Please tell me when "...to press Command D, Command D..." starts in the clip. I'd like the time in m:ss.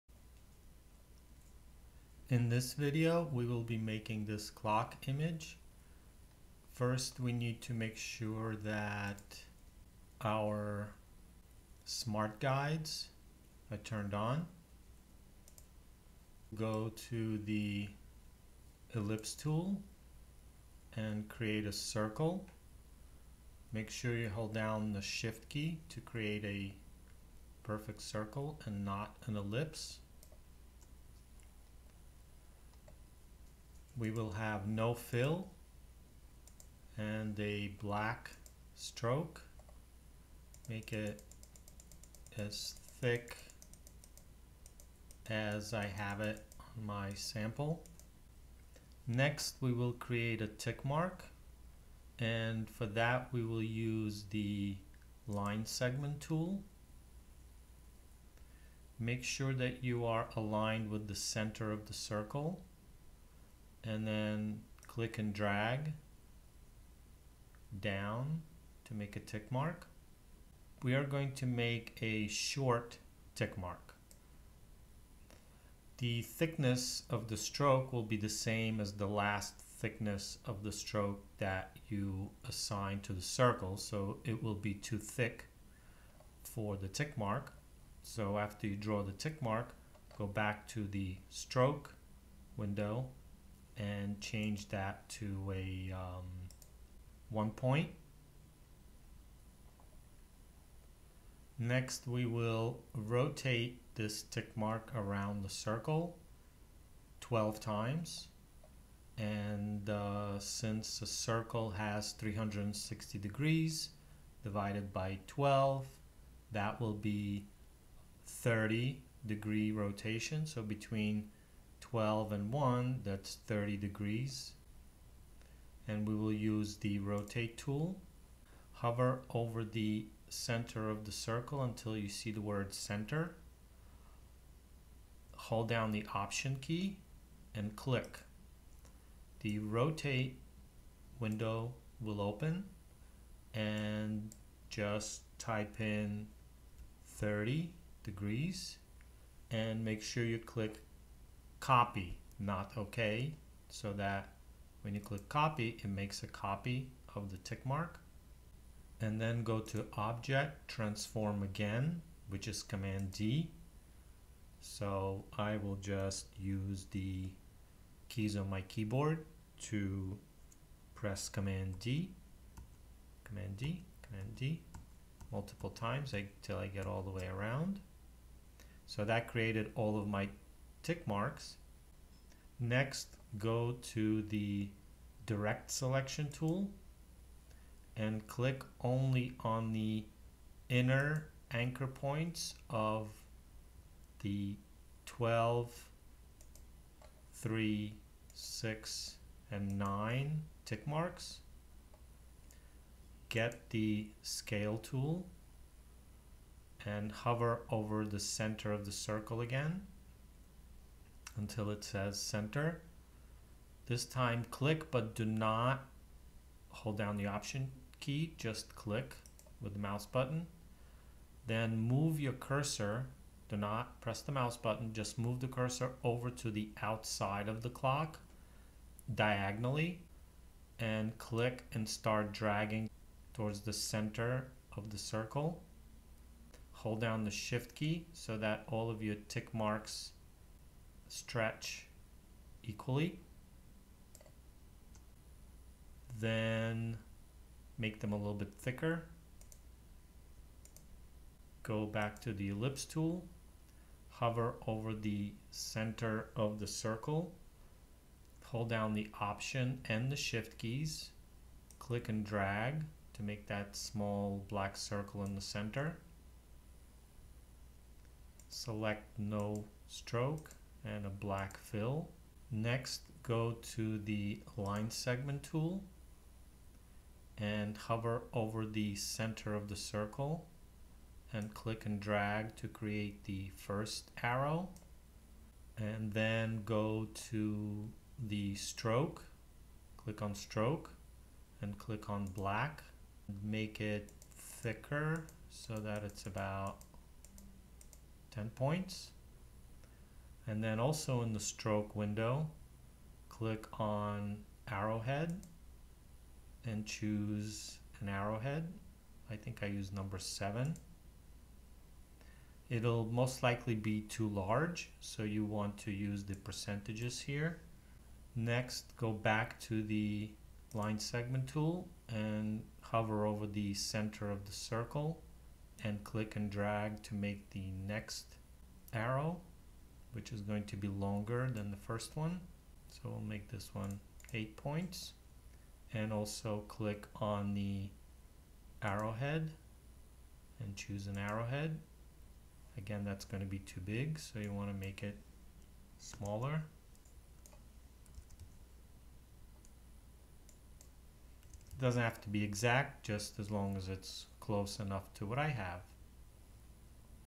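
2:49.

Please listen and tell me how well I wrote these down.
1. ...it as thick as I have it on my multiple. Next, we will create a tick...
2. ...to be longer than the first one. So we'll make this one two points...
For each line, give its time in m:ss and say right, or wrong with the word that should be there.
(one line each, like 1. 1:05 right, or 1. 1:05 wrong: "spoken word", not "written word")
1. 0:40 wrong: "sample", not "multiple"
2. 5:30 wrong: "eight", not "two".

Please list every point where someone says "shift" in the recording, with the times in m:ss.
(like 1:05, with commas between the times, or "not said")
0:25, 3:57, 4:20.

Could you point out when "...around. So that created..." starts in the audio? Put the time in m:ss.
2:57.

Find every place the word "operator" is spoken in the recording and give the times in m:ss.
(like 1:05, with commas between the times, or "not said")
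not said.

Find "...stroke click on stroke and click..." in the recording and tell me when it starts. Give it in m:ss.
4:48.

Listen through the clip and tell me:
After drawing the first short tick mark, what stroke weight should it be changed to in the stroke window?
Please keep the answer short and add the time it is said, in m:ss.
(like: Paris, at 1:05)
1 point, at 1:37.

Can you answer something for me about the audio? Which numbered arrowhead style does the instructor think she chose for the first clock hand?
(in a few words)
7.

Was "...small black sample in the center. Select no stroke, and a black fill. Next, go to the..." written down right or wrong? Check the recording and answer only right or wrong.
wrong.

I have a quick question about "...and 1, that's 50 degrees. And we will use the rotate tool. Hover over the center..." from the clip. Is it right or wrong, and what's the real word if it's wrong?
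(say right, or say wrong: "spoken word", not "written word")
wrong: "30", not "50".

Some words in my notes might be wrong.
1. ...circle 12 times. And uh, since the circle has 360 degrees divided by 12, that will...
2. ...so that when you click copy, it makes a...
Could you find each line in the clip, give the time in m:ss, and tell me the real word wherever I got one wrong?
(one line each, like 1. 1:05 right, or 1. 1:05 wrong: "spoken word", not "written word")
1. 1:45 right
2. 2:33 right.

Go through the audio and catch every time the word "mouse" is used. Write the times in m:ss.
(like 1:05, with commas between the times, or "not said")
3:39, 3:44.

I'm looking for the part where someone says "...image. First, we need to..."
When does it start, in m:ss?
0:05.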